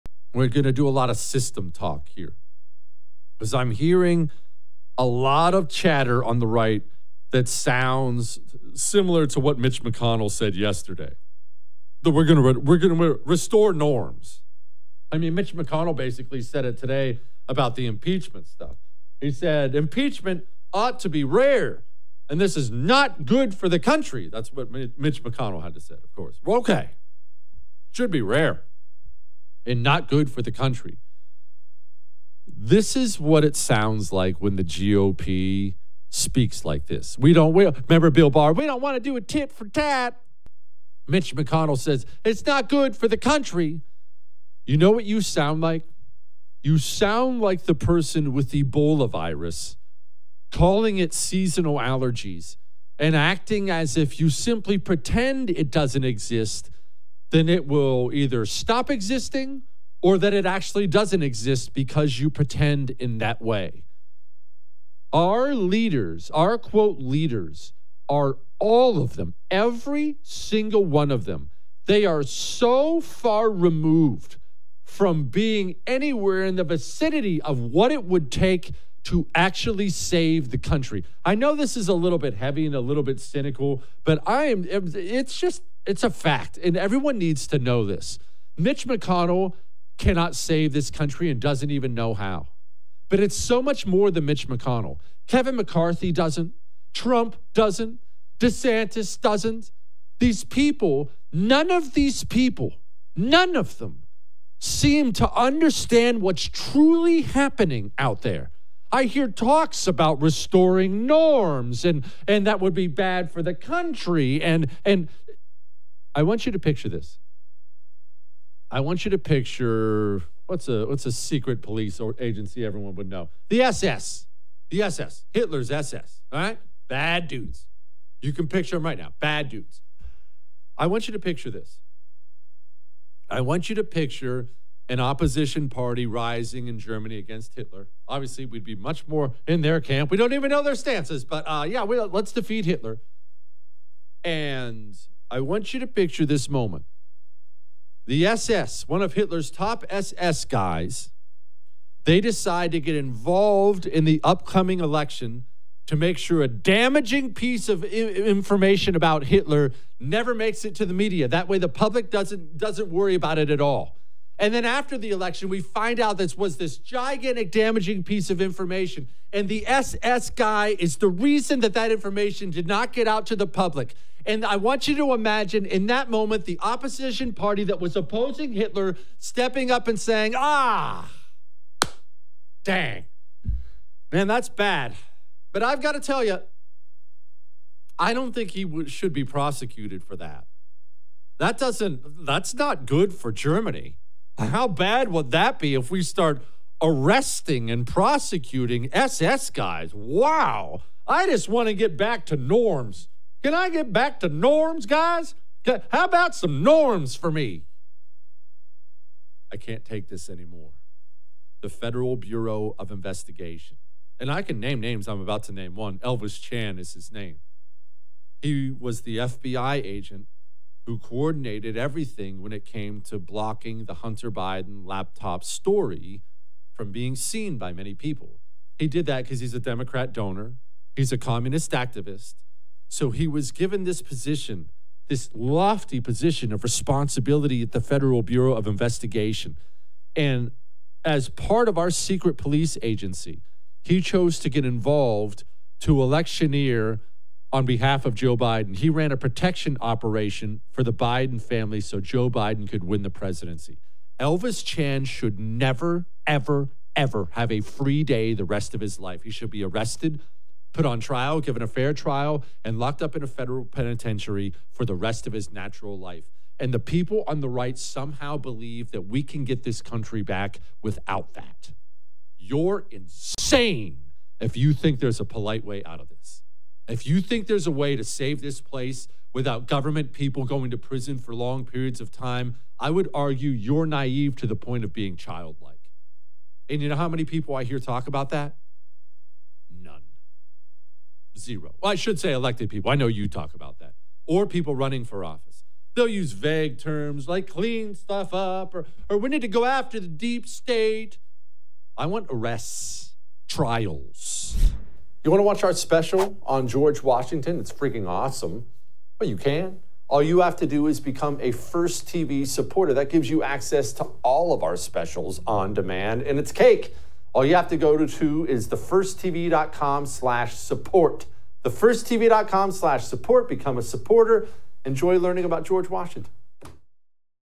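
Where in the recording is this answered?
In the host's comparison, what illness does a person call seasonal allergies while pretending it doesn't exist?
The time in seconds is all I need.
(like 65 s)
48 s.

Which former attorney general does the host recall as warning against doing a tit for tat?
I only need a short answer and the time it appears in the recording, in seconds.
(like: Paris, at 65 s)
Bill Barr, at 38 s.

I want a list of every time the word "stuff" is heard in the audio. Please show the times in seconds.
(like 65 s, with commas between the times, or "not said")
18 s, 297 s.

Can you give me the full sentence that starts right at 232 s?
So he was given this position, this lofty position of responsibility at the Federal Bureau of Investigation.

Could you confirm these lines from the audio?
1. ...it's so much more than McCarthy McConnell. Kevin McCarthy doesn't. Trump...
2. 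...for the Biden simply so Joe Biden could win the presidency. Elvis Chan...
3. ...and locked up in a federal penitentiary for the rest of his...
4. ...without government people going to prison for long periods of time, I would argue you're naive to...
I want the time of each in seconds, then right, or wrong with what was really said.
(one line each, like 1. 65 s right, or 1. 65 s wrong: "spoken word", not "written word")
1. 93 s wrong: "Mitch", not "McCarthy"
2. 250 s wrong: "family", not "simply"
3. 262 s right
4. 279 s right.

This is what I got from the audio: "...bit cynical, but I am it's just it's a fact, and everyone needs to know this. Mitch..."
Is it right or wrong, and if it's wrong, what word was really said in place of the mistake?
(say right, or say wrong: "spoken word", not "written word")
right.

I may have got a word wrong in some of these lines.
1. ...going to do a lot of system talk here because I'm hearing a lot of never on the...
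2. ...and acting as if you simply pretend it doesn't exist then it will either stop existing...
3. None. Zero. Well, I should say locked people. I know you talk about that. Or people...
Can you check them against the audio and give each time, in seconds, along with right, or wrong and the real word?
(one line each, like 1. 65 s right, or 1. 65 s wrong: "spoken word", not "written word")
1. 0 s wrong: "chatter", not "never"
2. 52 s right
3. 289 s wrong: "elected", not "locked".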